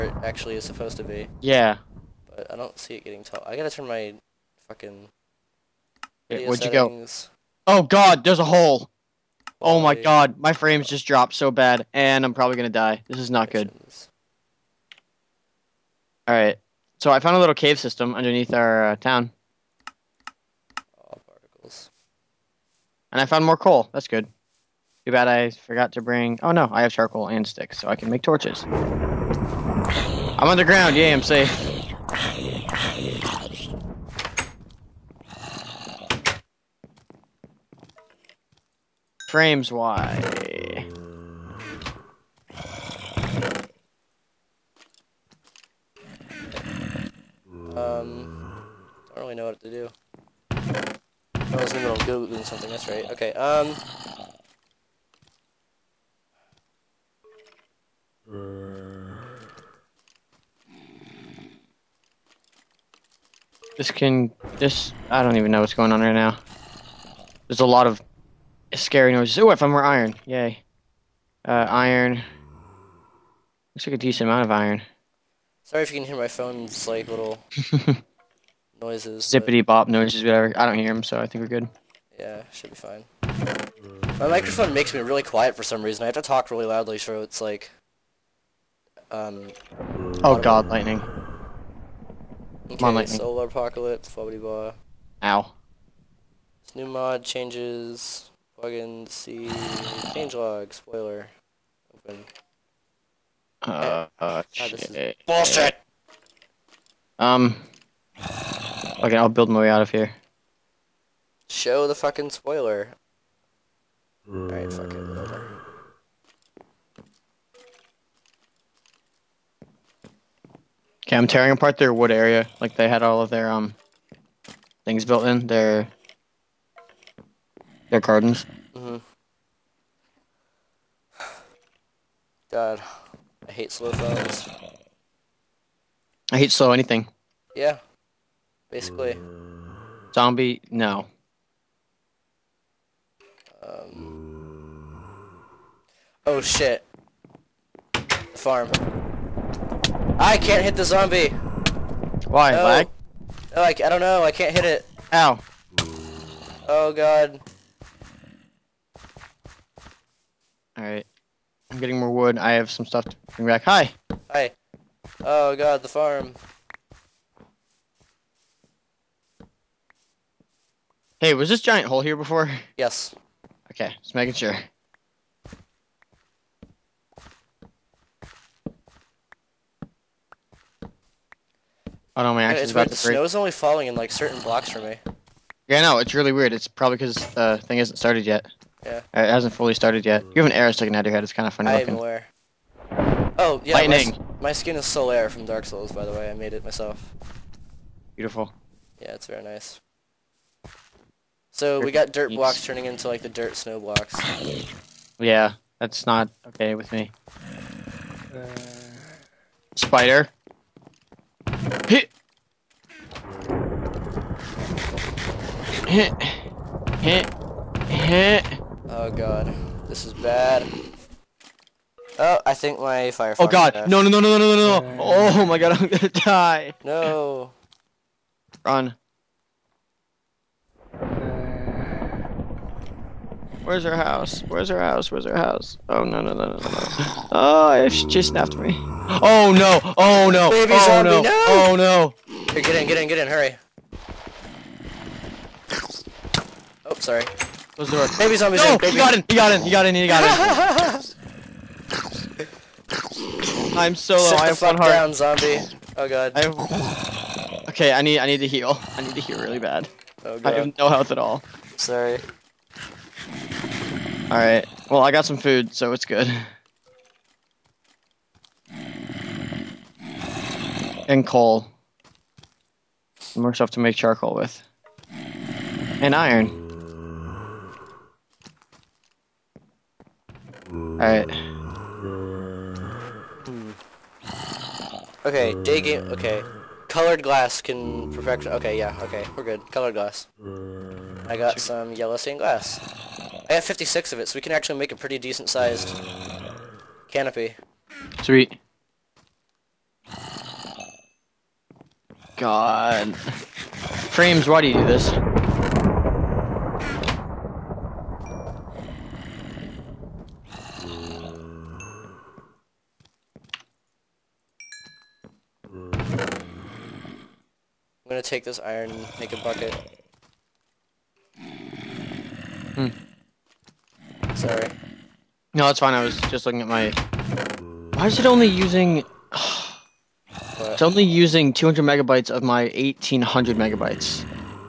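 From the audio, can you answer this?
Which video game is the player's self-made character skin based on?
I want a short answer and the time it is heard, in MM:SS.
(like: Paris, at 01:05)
Dark Souls, at 03:15.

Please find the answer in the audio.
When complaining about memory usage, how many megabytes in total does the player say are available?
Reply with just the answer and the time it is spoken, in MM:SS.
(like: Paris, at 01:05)
1800 megabytes, at 05:32.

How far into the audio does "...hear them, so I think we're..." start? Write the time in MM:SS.
01:20.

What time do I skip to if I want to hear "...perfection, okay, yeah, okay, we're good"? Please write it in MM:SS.
04:48.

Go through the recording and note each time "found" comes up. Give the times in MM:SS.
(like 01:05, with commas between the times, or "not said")
00:17, 00:23, 01:09.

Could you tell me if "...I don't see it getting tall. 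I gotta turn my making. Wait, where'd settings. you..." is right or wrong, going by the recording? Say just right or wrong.
wrong.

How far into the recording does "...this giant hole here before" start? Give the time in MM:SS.
02:51.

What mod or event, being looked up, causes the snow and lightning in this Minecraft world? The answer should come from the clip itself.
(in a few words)
Solar Apocalypse.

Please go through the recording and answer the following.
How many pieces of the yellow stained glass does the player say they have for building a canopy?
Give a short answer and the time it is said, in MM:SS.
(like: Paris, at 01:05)
56, at 04:53.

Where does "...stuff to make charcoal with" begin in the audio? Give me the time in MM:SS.
04:33.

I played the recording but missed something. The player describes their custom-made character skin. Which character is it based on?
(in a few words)
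Solaire.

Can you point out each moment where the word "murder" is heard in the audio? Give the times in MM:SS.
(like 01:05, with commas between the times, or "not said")
not said.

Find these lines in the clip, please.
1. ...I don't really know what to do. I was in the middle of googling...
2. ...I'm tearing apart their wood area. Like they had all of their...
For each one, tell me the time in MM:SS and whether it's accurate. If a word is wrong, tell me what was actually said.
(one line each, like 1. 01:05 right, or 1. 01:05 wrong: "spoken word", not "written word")
1. 00:48 right
2. 02:01 right.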